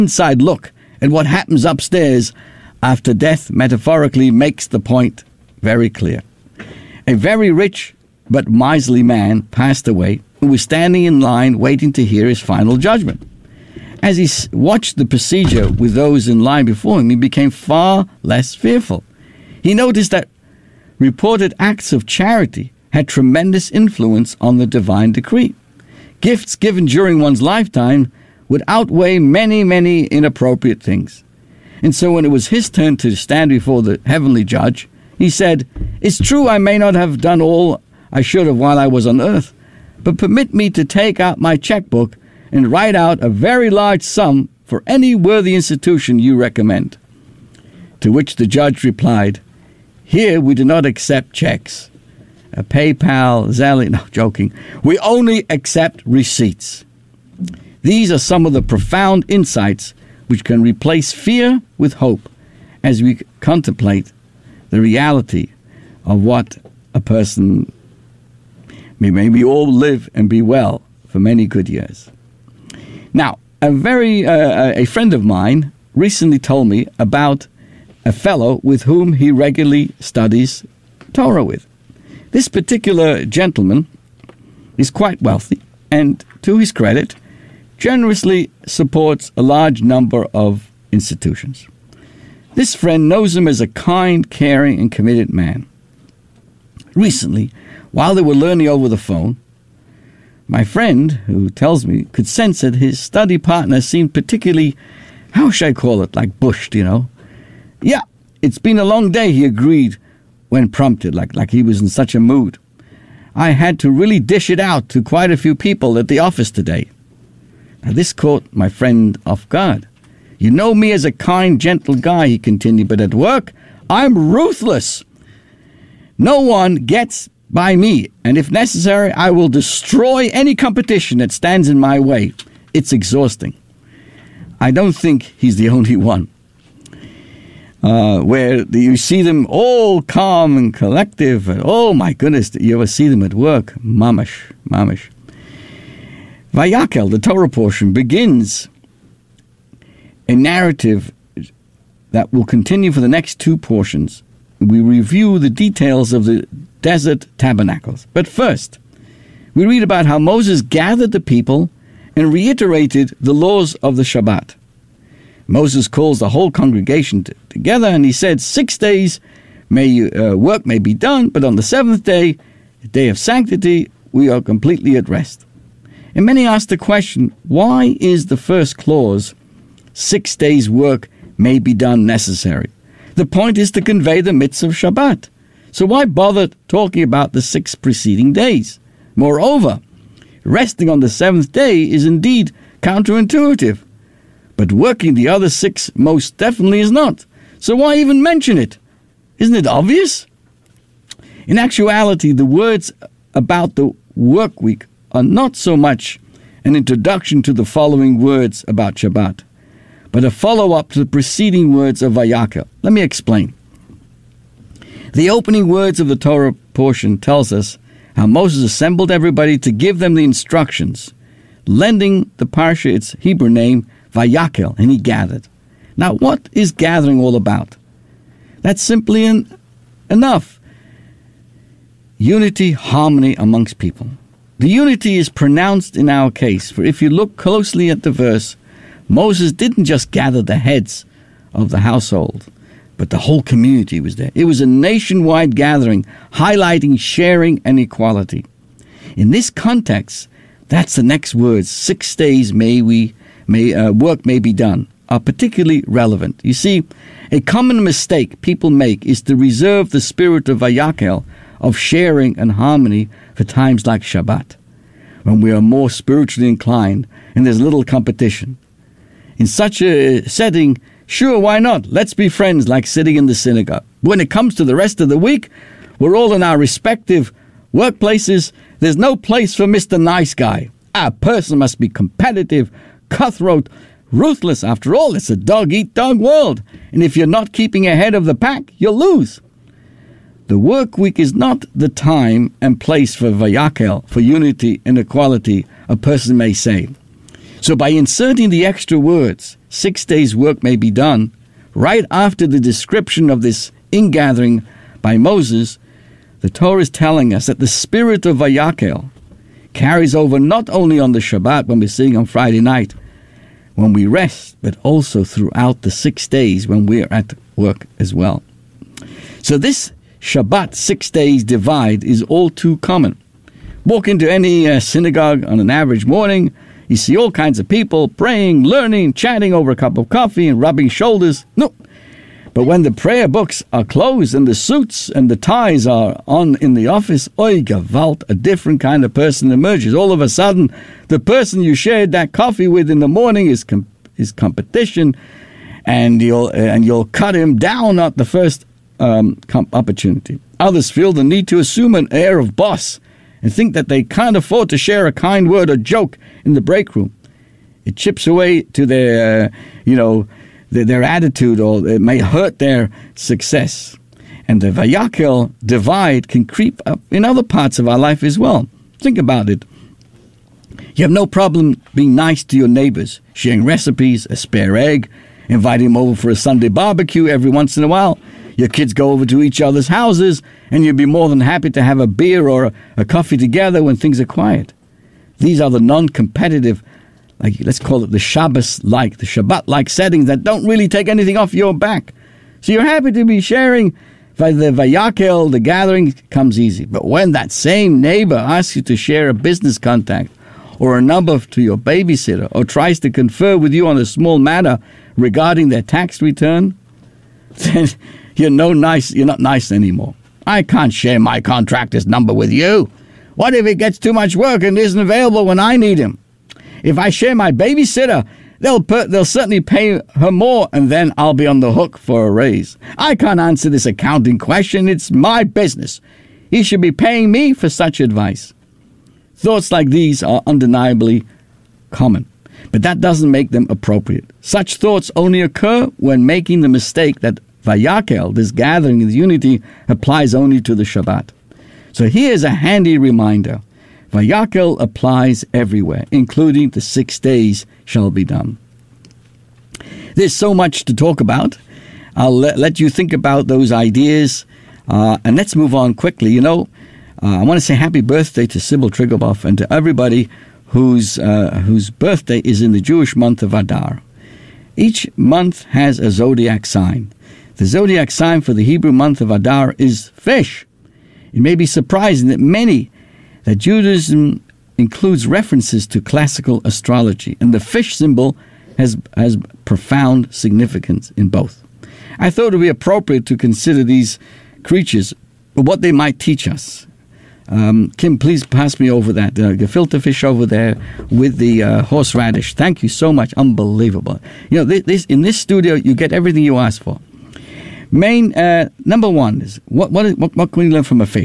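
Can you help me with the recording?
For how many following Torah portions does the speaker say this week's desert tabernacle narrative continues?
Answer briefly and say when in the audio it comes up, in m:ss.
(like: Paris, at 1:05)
2, at 2:33.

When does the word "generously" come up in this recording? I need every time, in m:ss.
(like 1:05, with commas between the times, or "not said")
1:27.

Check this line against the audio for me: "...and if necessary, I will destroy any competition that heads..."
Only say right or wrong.
wrong.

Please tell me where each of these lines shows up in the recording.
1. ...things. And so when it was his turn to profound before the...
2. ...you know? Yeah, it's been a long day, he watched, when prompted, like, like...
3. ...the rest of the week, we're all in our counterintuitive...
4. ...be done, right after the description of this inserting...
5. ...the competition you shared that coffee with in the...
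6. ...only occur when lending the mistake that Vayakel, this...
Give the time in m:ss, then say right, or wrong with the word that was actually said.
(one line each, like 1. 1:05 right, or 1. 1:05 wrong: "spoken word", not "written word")
1. 0:30 wrong: "stand", not "profound"
2. 1:46 wrong: "agreed", not "watched"
3. 4:34 wrong: "respective", not "counterintuitive"
4. 5:00 wrong: "ingathering", not "inserting"
5. 5:41 wrong: "person", not "competition"
6. 7:15 wrong: "making", not "lending".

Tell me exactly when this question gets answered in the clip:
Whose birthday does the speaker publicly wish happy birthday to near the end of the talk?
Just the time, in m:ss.
7:38.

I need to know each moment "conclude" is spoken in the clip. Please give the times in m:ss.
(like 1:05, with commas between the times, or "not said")
not said.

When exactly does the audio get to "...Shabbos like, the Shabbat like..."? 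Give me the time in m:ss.
6:28.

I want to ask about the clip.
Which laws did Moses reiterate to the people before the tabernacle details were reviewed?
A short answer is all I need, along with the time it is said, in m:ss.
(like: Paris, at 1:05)
The laws of the Shabbat, at 2:43.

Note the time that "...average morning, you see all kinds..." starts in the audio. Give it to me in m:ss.
5:25.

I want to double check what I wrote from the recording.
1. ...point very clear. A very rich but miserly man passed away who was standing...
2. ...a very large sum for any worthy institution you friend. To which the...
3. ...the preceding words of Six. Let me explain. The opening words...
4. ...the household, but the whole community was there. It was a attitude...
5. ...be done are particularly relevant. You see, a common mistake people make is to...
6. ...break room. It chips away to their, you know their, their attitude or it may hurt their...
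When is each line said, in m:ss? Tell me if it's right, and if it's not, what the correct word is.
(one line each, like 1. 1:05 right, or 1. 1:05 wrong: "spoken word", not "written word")
1. 0:04 right
2. 0:43 wrong: "recommend", not "friend"
3. 3:30 wrong: "Vayakel", not "Six"
4. 4:01 wrong: "nationwide", not "attitude"
5. 4:14 right
6. 5:56 right.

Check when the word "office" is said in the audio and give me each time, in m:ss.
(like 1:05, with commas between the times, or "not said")
1:56, 5:36.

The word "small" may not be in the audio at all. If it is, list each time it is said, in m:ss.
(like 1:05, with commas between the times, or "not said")
6:44.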